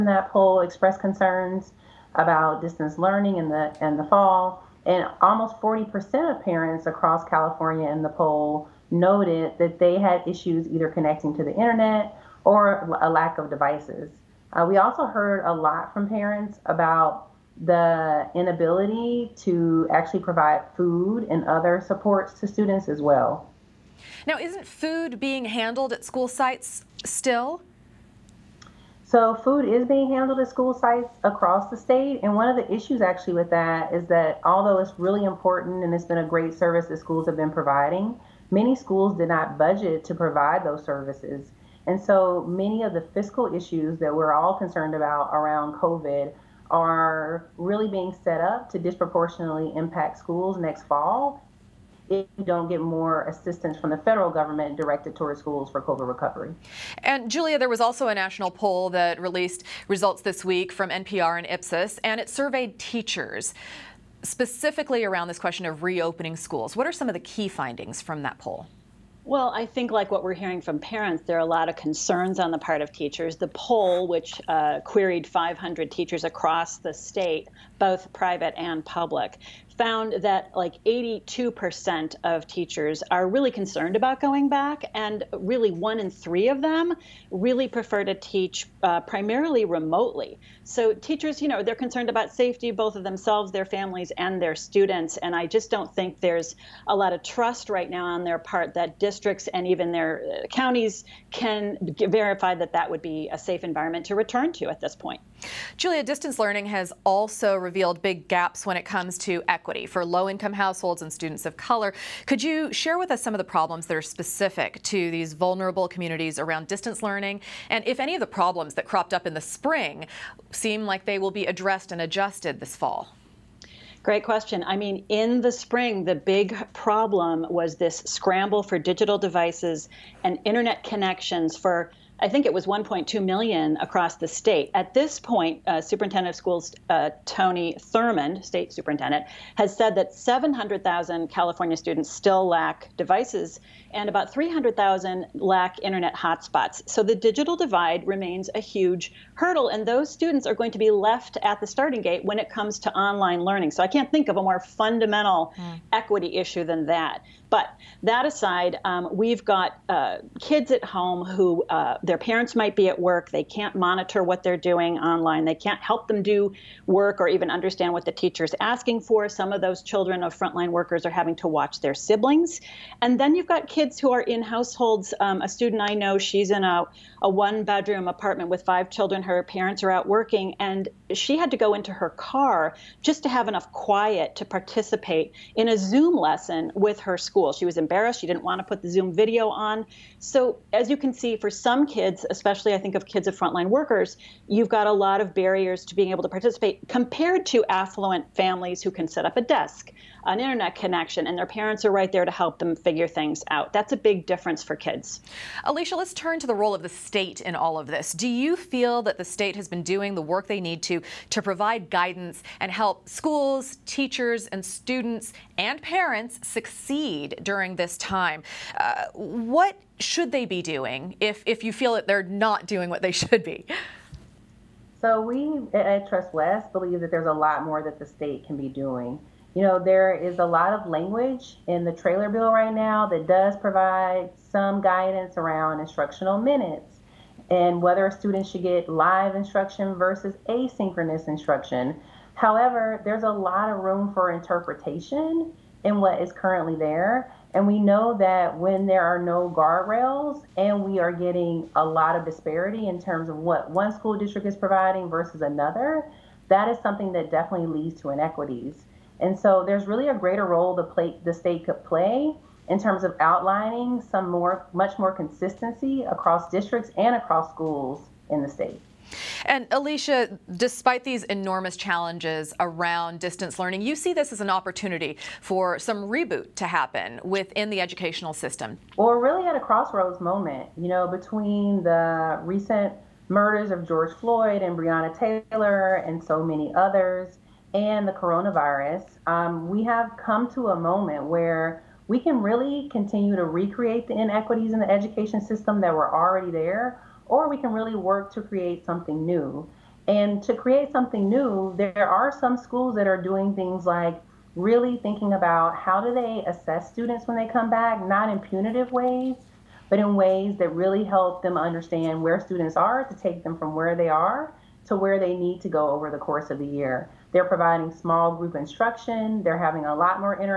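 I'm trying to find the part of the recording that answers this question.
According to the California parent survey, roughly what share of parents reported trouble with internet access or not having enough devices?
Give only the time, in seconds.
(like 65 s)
5 s.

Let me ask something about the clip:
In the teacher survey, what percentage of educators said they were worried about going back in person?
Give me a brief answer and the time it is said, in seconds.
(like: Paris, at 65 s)
82%, at 80 s.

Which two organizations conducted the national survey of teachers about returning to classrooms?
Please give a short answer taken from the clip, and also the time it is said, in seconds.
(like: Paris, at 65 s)
NPR and Ipsos, at 60 s.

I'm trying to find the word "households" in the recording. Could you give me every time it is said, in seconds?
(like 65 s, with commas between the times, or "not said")
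110 s, 174 s.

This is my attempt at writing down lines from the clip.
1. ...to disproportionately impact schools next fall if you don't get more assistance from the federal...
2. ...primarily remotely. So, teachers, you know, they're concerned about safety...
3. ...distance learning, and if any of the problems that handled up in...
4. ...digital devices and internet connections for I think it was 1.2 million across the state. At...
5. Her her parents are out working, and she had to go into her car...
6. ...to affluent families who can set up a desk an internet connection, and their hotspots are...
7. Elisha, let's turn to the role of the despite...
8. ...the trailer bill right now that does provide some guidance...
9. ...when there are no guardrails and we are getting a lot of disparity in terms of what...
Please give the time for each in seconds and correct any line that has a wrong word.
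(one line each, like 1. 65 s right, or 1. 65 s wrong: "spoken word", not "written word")
1. 48 s right
2. 89 s right
3. 116 s wrong: "cropped", not "handled"
4. 128 s right
5. 179 s right
6. 197 s wrong: "parents", not "hotspots"
7. 205 s wrong: "state", not "despite"
8. 231 s right
9. 248 s right.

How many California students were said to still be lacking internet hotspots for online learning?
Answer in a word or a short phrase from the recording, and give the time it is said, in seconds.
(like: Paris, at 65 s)
300,000, at 144 s.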